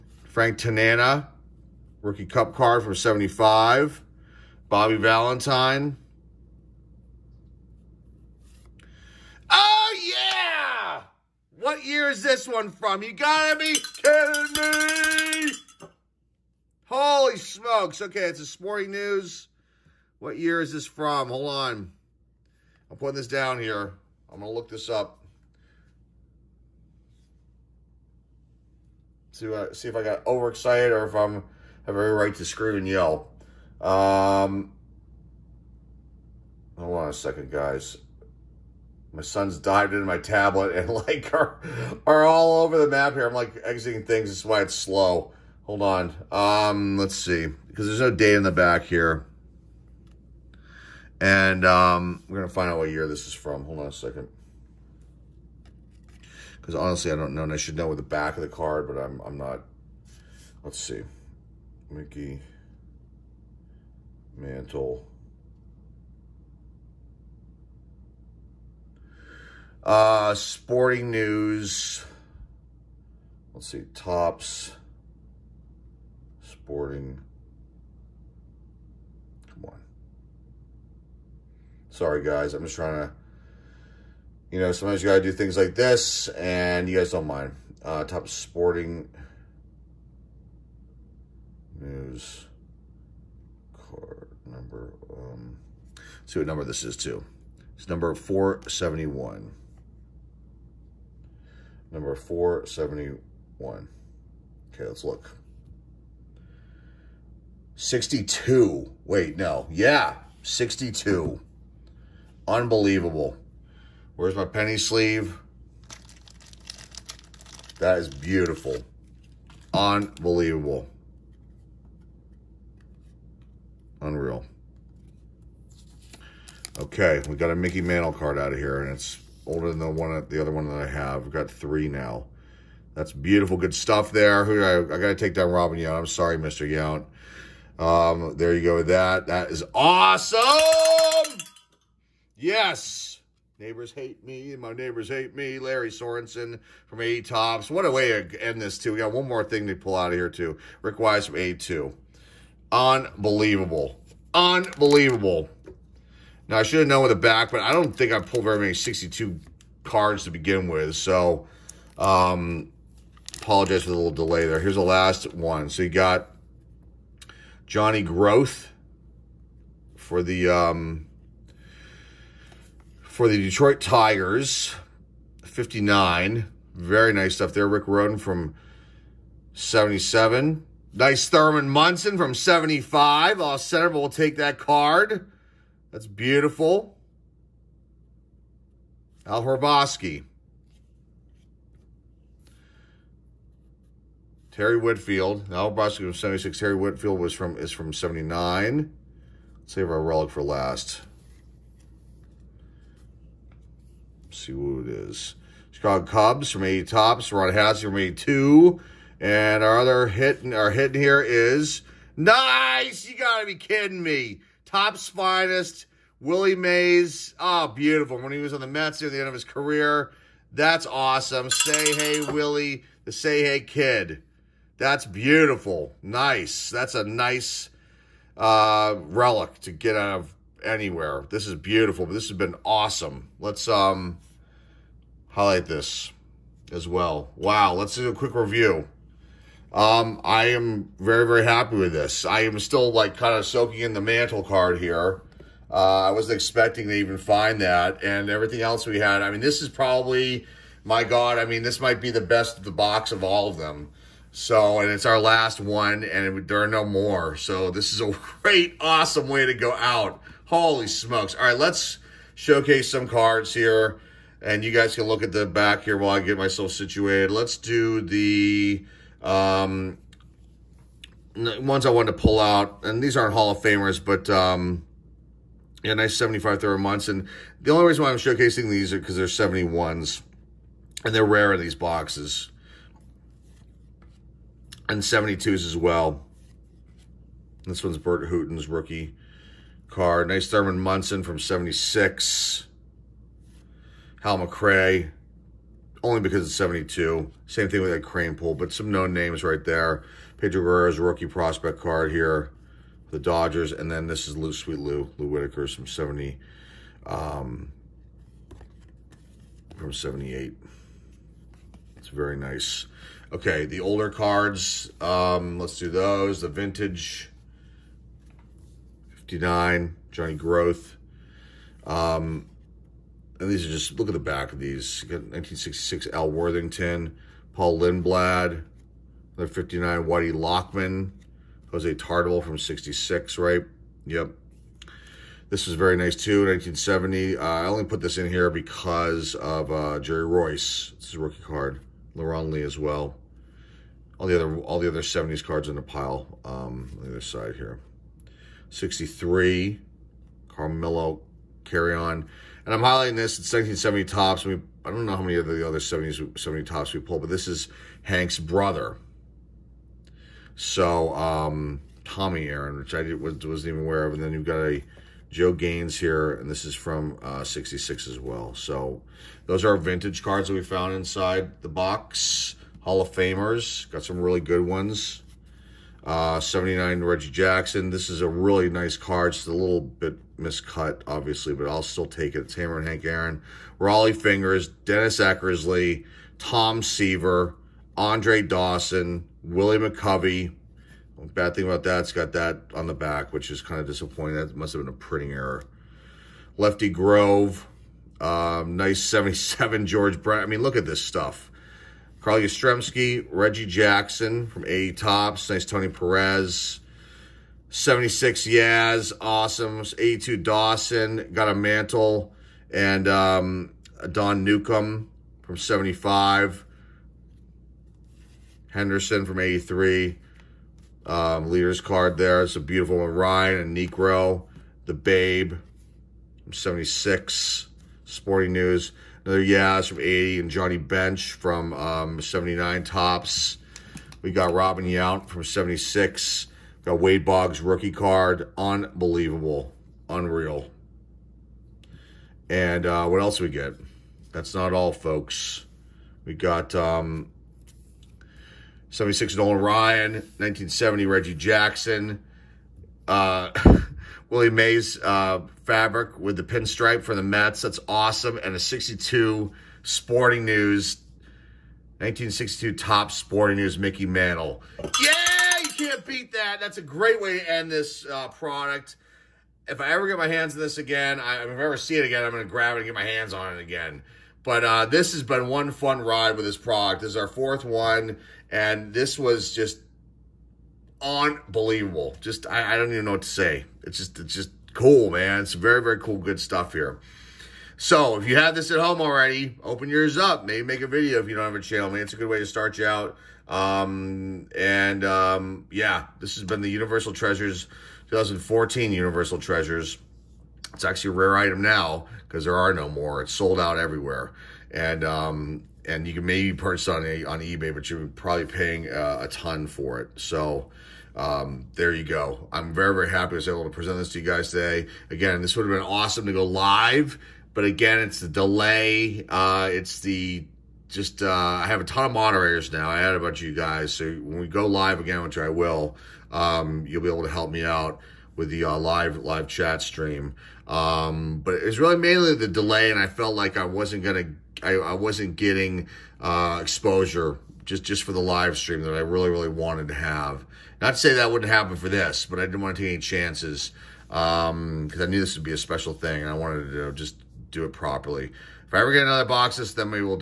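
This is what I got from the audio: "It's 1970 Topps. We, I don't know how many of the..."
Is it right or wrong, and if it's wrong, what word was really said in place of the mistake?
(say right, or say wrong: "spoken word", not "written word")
right.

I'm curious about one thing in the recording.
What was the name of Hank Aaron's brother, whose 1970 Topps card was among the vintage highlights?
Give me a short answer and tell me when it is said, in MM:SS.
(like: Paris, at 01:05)
Tommy Aaron, at 06:02.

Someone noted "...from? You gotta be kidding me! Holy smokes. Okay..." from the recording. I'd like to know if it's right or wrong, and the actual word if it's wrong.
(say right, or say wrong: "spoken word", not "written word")
right.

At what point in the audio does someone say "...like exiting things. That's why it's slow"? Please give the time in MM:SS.
00:43.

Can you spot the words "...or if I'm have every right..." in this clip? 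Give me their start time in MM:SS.
00:30.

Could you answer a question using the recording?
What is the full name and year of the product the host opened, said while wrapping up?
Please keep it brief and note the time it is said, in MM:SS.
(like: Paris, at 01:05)
2014 Universal Treasures, at 08:18.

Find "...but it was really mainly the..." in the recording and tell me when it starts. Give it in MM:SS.
08:51.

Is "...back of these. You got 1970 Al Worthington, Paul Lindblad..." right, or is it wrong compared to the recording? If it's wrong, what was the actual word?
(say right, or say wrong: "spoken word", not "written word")
wrong: "1966", not "1970".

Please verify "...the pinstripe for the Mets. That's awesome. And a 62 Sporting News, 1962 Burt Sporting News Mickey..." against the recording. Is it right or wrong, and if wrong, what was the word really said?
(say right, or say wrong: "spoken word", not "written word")
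wrong: "Topps", not "Burt".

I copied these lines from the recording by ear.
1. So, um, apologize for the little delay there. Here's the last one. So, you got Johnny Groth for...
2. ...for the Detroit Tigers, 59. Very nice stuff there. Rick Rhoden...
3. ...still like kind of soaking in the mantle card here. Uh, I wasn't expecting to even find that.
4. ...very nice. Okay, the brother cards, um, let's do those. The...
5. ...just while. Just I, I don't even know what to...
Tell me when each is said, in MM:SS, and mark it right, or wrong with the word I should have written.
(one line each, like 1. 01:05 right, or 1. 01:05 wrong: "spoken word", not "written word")
1. 02:40 right
2. 02:53 right
3. 04:02 right
4. 05:12 wrong: "older", not "brother"
5. 07:59 wrong: "unbelievable", not "while".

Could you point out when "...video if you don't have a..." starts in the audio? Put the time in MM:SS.
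08:10.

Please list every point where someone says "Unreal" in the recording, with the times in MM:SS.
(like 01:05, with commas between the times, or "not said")
02:03, 07:20.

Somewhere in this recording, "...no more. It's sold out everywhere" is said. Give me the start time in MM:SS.
08:22.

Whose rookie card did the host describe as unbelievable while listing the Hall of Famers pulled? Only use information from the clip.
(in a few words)
Wade Boggs.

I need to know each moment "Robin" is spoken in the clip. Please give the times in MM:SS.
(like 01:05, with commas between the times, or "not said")
02:15, 07:14.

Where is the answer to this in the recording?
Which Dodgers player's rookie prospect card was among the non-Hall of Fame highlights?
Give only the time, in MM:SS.
05:00.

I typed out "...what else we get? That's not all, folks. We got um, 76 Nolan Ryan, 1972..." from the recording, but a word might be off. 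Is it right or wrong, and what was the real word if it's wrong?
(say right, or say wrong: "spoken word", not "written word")
wrong: "1970", not "1972".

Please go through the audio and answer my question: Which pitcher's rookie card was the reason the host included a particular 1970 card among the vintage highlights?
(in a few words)
Jerry Reuss.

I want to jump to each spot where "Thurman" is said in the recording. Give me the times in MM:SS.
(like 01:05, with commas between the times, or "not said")
03:01, 04:50.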